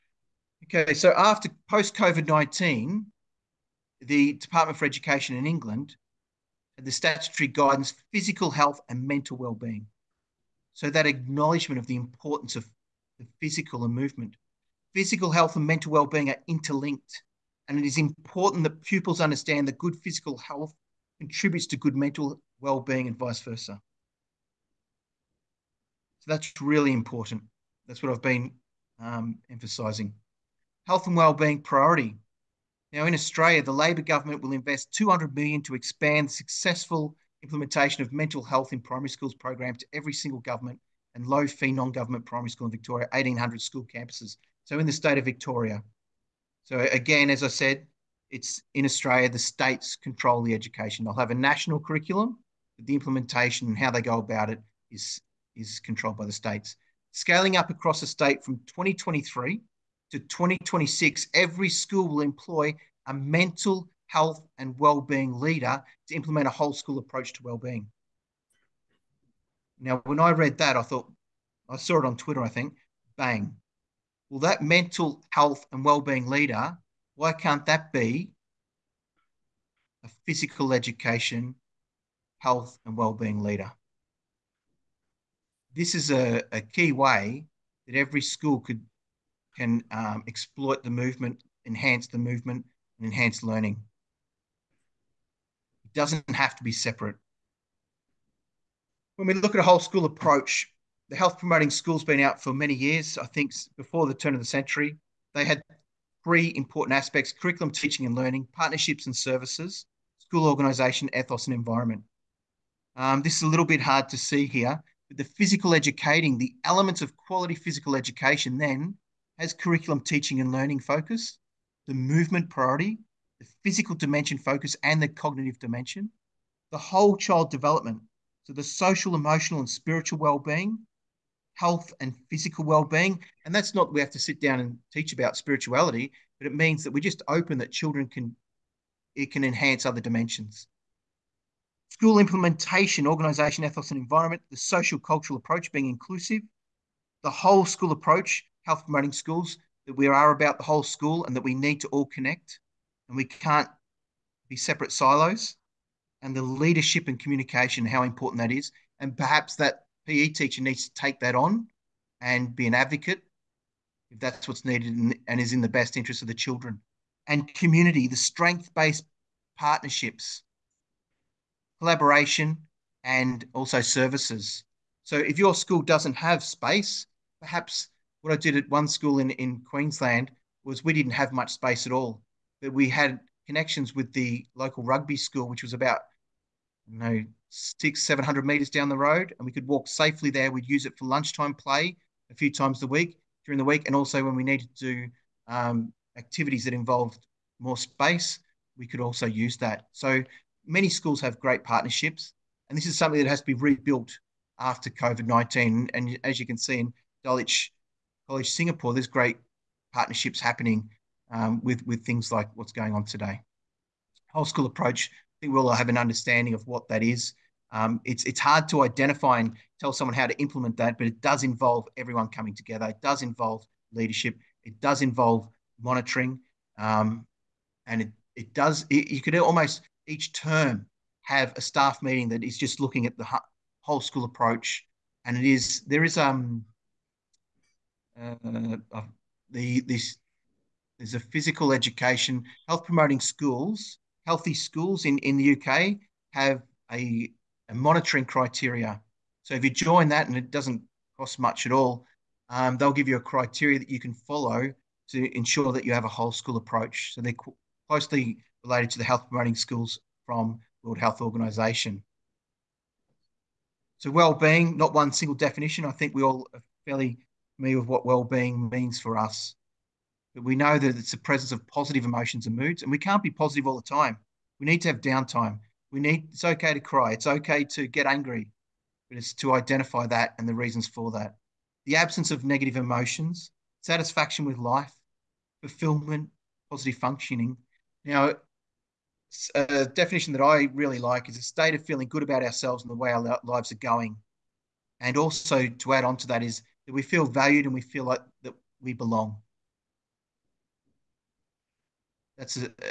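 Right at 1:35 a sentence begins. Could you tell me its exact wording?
It doesn't have to be separate.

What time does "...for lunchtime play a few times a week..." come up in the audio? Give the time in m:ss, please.
3:10.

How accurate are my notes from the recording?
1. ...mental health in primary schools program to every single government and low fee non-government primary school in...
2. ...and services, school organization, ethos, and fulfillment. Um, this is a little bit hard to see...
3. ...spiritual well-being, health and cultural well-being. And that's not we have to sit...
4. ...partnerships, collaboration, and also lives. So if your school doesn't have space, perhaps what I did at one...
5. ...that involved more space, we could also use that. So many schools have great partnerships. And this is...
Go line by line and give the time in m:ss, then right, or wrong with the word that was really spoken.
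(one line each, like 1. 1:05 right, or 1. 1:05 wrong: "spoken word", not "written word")
1. 0:38 right
2. 1:49 wrong: "environment", not "fulfillment"
3. 2:09 wrong: "physical", not "cultural"
4. 2:49 wrong: "services", not "lives"
5. 3:16 right.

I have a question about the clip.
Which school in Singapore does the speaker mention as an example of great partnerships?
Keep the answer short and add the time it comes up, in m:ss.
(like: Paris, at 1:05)
Dulwich College Singapore, at 3:27.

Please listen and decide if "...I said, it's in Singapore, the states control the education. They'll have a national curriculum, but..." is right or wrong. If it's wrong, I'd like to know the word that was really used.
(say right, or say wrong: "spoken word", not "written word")
wrong: "Australia", not "Singapore".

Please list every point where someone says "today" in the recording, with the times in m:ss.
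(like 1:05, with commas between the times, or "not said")
3:33.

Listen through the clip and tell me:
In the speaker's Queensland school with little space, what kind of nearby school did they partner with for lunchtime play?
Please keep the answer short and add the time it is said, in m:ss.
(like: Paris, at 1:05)
rugby school, at 3:04.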